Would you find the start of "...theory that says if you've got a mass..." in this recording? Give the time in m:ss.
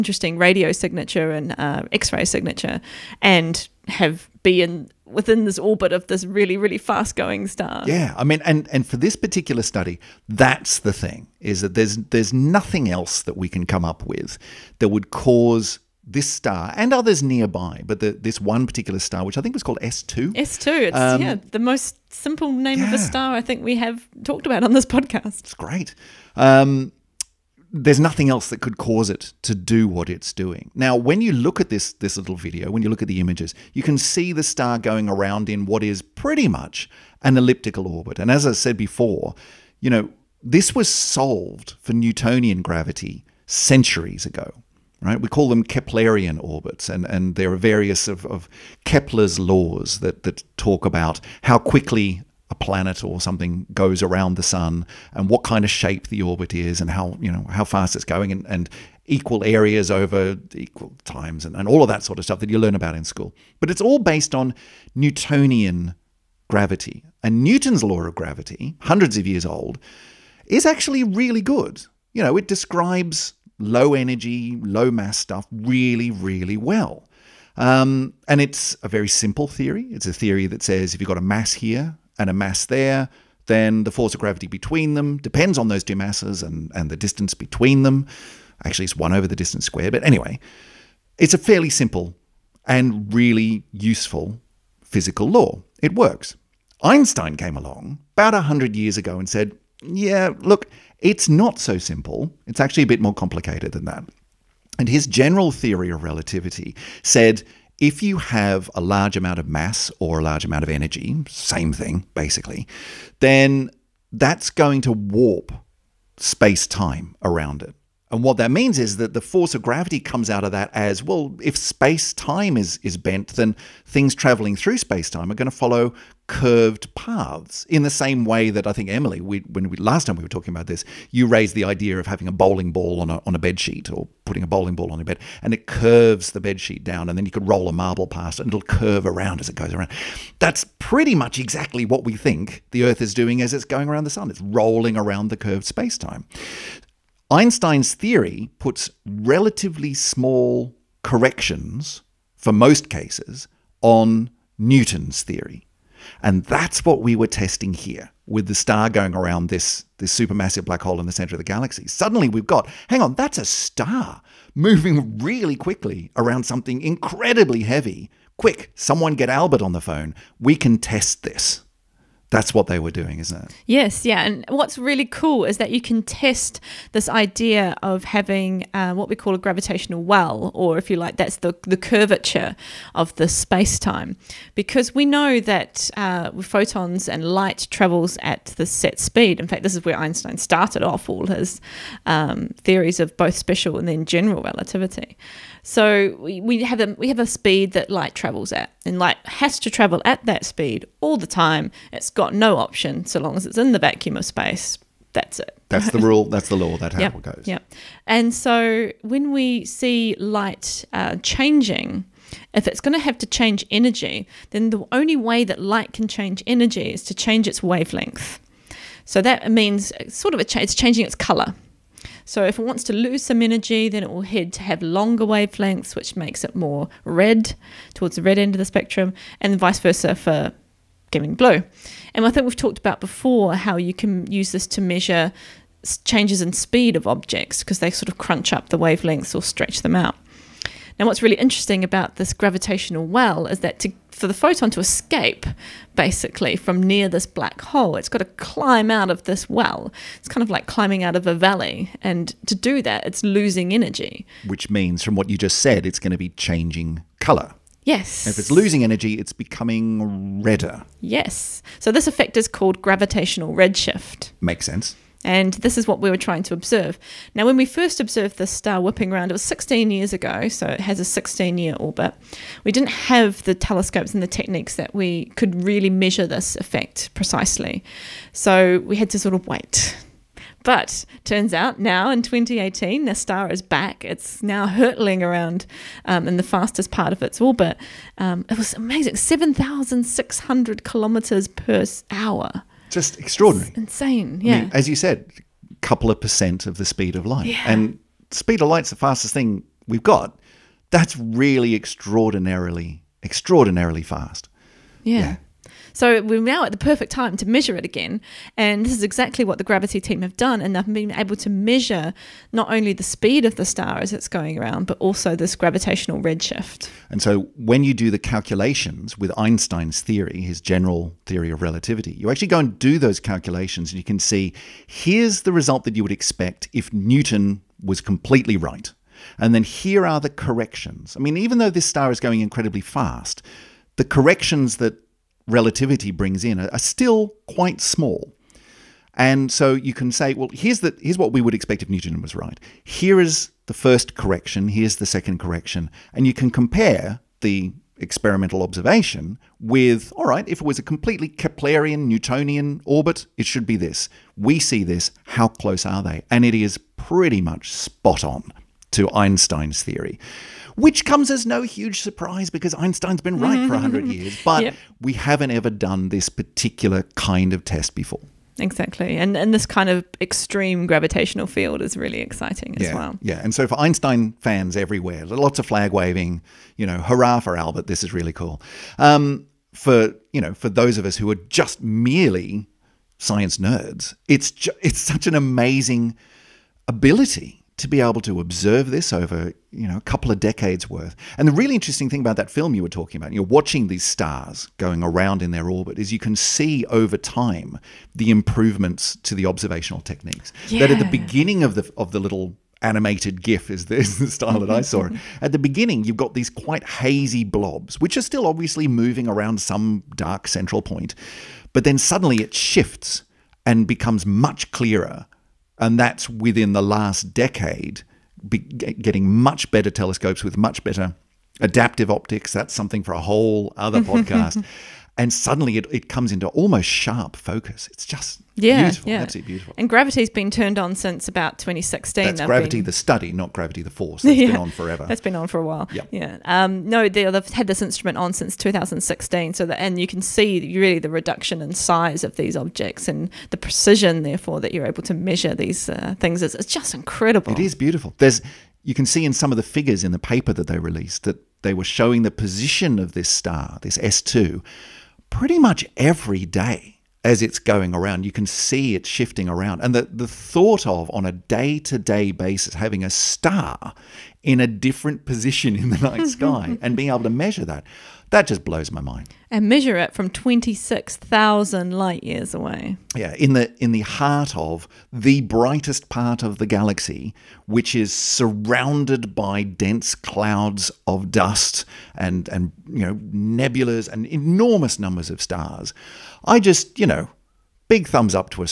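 1:20.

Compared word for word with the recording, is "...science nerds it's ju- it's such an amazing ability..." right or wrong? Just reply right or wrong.
right.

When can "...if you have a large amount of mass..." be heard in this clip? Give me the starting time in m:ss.
1:47.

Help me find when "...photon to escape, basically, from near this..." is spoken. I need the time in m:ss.
4:04.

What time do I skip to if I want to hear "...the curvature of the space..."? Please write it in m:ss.
3:01.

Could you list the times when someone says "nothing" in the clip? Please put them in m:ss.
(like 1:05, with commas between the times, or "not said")
0:12, 0:27.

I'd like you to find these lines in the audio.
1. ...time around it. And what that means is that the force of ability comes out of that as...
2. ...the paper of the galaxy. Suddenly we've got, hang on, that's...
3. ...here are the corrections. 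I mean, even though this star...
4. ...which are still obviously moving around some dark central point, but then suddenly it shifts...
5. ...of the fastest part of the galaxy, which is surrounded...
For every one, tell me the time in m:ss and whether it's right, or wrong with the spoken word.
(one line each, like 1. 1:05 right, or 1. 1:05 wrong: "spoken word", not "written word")
1. 1:56 wrong: "gravity", not "ability"
2. 2:41 wrong: "center", not "paper"
3. 5:29 right
4. 6:47 right
5. 7:54 wrong: "brightest", not "fastest".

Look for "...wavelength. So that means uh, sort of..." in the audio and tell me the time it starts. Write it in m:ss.
3:37.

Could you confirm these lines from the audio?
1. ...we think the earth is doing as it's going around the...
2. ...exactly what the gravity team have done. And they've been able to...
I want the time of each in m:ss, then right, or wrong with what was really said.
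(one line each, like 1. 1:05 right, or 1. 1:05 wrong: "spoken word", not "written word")
1. 2:22 right
2. 5:09 right.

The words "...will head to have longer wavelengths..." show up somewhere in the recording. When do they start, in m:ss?
3:44.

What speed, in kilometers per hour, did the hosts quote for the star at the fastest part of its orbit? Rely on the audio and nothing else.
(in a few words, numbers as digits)
7,600 km/h.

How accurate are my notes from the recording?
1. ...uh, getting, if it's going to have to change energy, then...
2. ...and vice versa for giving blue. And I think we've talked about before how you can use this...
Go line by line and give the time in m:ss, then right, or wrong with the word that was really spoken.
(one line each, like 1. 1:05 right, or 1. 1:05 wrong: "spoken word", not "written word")
1. 3:30 wrong: "changing", not "getting"
2. 3:49 right.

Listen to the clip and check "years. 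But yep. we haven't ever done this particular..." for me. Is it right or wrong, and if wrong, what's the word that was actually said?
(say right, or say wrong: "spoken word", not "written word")
right.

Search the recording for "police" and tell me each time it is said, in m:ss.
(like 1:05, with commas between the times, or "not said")
not said.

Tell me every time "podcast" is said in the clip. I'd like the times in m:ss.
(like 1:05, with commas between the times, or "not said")
0:24, 7:04.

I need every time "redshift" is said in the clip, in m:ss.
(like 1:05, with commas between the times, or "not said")
4:23, 5:16.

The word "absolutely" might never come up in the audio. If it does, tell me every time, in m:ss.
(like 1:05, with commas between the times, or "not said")
7:09.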